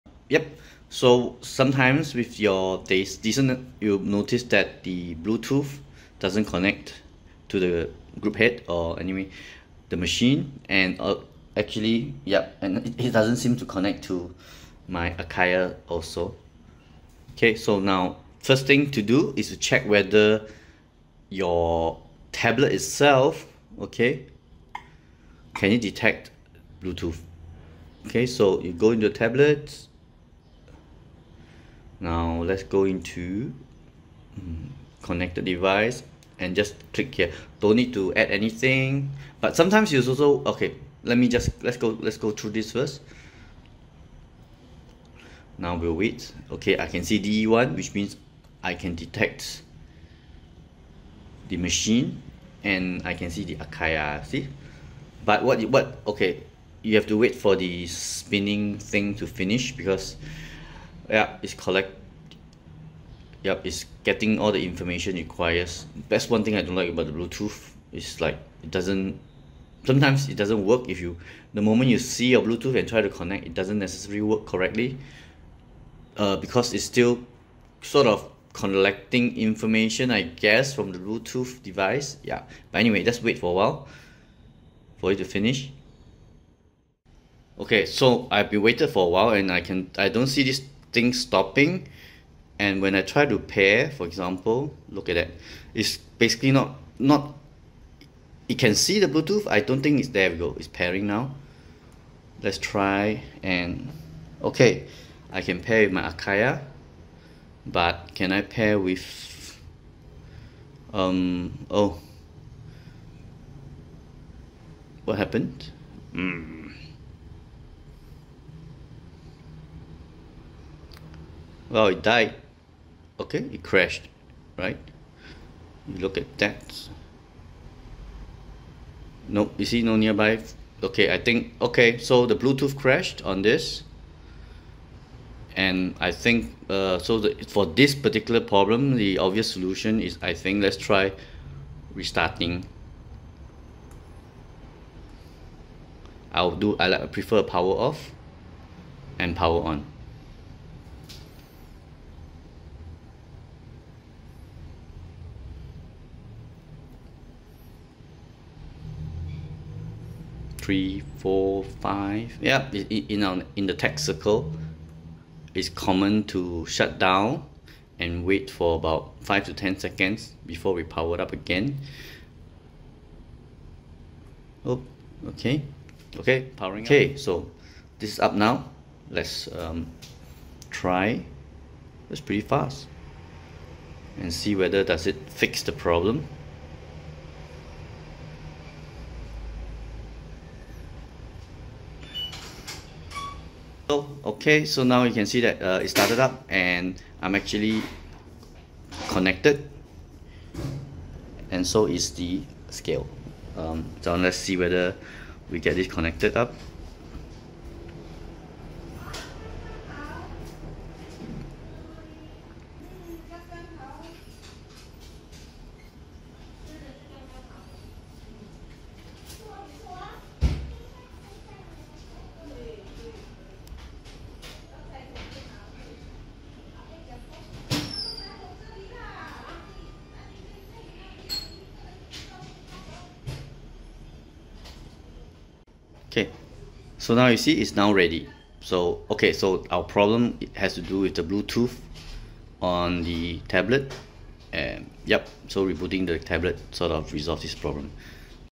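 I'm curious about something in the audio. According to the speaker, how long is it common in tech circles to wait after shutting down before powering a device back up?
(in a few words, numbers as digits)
5 to 10 seconds.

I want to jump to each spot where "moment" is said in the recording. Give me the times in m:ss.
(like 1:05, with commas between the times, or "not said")
1:11.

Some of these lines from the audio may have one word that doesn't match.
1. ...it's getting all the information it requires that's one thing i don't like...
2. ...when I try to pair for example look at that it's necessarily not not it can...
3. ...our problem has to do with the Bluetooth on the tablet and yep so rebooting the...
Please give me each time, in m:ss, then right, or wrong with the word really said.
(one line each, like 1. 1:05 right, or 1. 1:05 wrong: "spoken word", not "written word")
1. 1:03 right
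2. 1:32 wrong: "basically", not "necessarily"
3. 3:59 right.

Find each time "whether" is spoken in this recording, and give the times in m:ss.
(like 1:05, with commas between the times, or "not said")
0:19, 3:04, 3:24.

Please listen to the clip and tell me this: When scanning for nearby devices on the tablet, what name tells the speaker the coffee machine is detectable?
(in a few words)
DE1.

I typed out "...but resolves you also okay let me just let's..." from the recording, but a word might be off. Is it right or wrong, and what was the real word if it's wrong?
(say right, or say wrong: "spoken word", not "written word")
wrong: "sometimes", not "resolves".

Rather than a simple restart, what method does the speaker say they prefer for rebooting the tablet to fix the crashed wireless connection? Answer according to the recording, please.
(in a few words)
Power off and power on.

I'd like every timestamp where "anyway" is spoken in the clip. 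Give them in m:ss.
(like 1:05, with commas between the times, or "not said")
0:08, 1:22.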